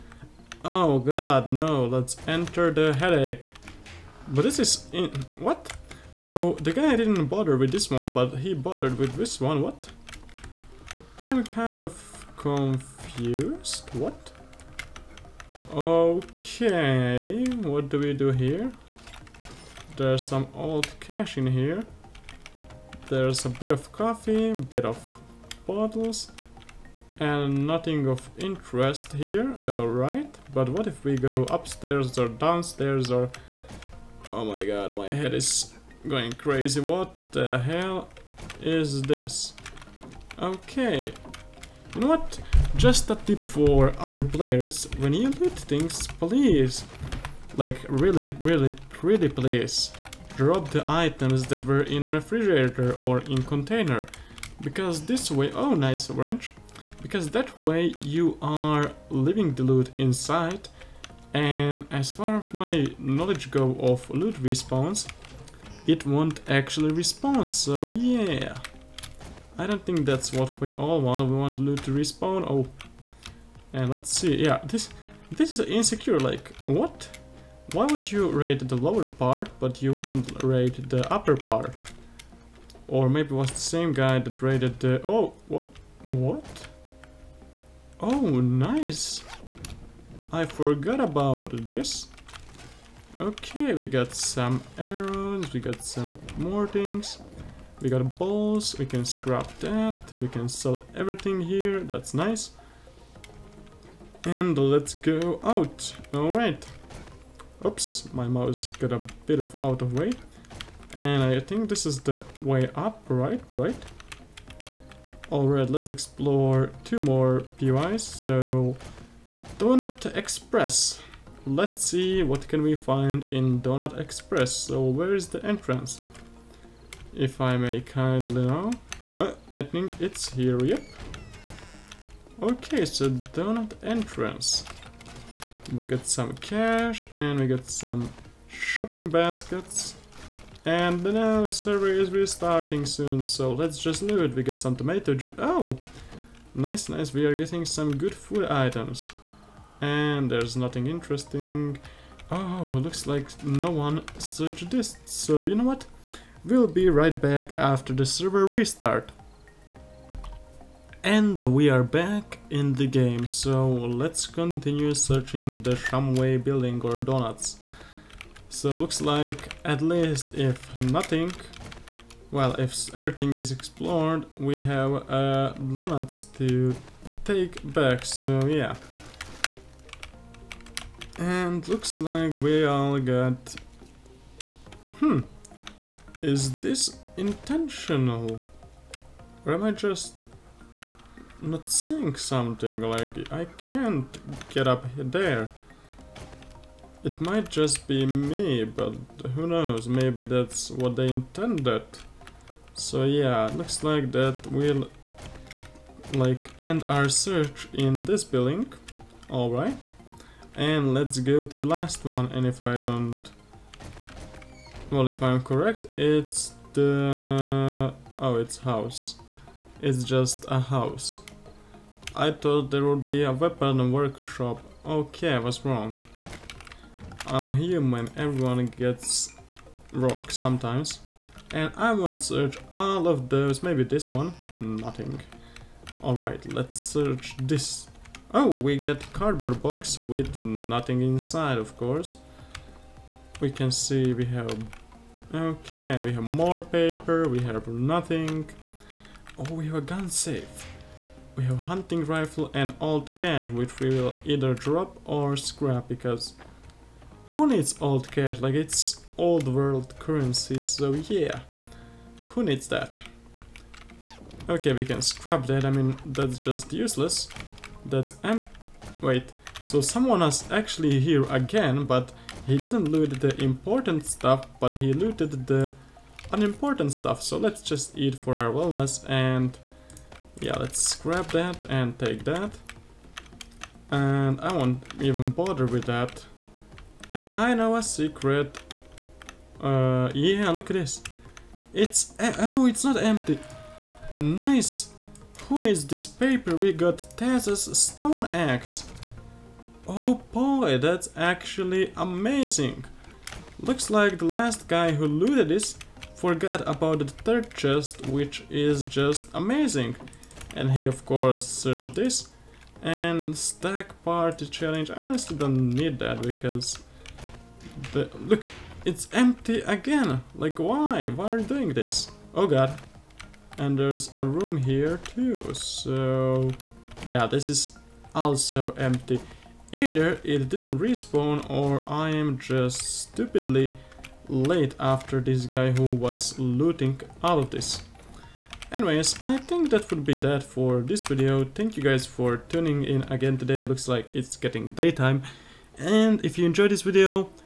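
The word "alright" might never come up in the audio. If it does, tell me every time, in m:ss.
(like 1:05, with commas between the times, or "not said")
0:29, 1:46, 1:55, 3:29, 3:56.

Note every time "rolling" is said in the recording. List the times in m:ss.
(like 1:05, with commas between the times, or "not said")
not said.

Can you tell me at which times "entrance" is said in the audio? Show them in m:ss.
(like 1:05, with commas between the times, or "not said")
2:05, 2:13.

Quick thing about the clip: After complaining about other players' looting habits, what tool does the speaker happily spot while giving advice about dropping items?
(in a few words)
Wrench.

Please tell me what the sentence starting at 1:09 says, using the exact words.
I don't think that's what we all want.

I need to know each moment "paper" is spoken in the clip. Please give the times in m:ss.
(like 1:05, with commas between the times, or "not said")
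4:06, 4:56.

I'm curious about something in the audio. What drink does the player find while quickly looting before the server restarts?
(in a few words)
Tomato juice.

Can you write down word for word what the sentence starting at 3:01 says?
And looks like we all got...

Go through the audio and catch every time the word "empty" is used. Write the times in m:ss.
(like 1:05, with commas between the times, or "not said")
4:52, 5:19, 5:28.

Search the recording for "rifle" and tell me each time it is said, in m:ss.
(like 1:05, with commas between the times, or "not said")
4:12.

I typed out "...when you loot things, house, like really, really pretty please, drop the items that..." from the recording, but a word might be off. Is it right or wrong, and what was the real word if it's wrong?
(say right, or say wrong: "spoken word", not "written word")
wrong: "please", not "house".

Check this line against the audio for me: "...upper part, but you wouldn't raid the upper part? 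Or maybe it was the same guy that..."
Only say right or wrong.
wrong.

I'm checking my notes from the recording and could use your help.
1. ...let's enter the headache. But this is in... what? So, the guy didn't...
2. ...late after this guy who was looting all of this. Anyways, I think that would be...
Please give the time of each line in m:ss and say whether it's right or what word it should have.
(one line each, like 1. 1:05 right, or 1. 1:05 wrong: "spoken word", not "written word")
1. 0:01 right
2. 5:34 right.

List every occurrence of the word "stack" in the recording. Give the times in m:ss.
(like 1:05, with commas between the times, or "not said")
5:13.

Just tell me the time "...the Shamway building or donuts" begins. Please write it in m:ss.
2:45.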